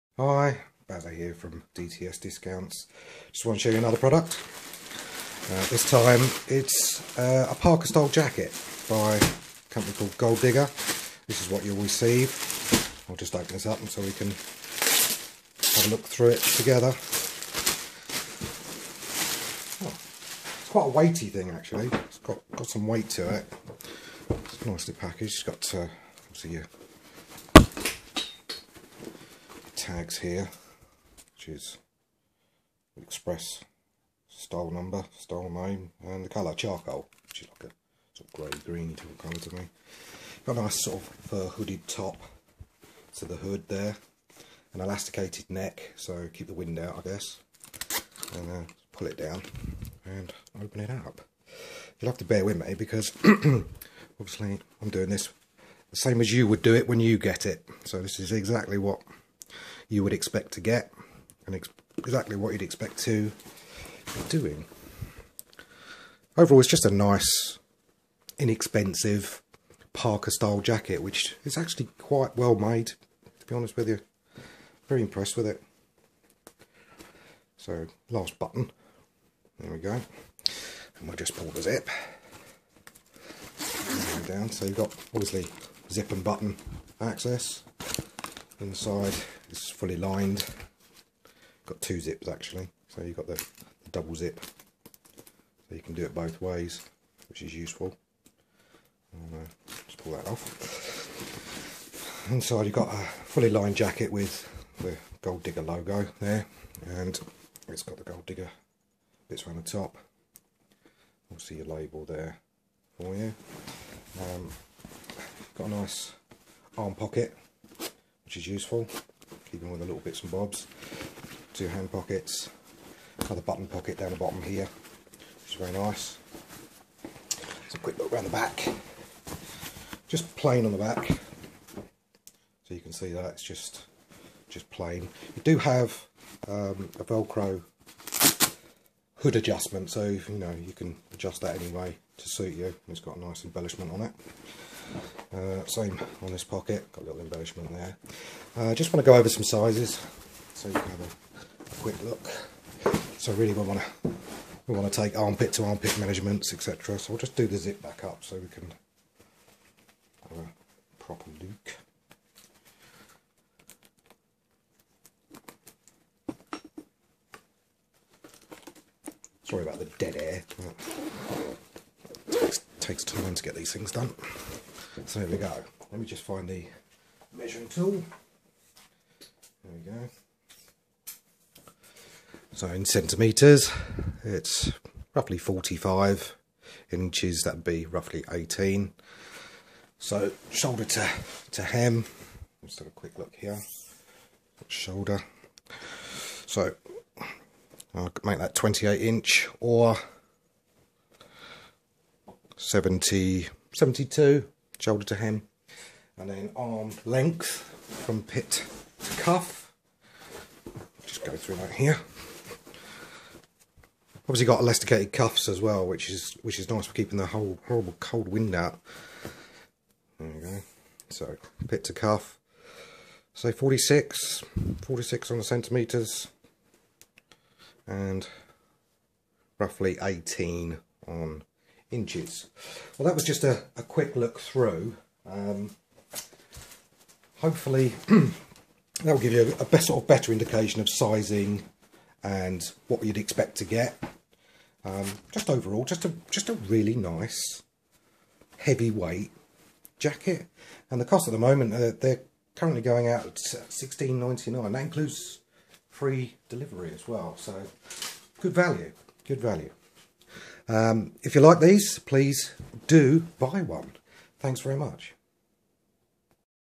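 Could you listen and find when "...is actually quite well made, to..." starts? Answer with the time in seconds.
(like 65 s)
71 s.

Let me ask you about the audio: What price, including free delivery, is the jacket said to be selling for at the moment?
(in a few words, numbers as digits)
16.99.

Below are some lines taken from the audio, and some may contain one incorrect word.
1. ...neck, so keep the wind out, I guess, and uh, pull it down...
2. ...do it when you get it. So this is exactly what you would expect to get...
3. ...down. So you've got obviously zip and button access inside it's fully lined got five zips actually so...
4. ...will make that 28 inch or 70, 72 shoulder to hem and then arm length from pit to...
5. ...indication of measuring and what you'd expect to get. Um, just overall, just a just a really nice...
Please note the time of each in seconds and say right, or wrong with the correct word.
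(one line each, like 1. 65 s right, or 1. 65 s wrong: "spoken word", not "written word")
1. 45 s right
2. 56 s right
3. 84 s wrong: "two", not "five"
4. 198 s right
5. 240 s wrong: "sizing", not "measuring".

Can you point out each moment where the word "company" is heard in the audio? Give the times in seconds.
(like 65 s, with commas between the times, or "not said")
9 s.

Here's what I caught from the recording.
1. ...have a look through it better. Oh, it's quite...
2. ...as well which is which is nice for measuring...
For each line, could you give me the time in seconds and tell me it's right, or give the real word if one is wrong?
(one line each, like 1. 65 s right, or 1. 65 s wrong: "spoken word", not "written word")
1. 14 s wrong: "together", not "better"
2. 215 s wrong: "keeping", not "measuring".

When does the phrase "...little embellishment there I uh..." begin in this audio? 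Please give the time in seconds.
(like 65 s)
147 s.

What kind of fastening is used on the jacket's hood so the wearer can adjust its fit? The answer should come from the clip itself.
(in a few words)
Velcro.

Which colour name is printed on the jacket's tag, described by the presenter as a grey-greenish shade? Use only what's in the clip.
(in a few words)
Charcoal.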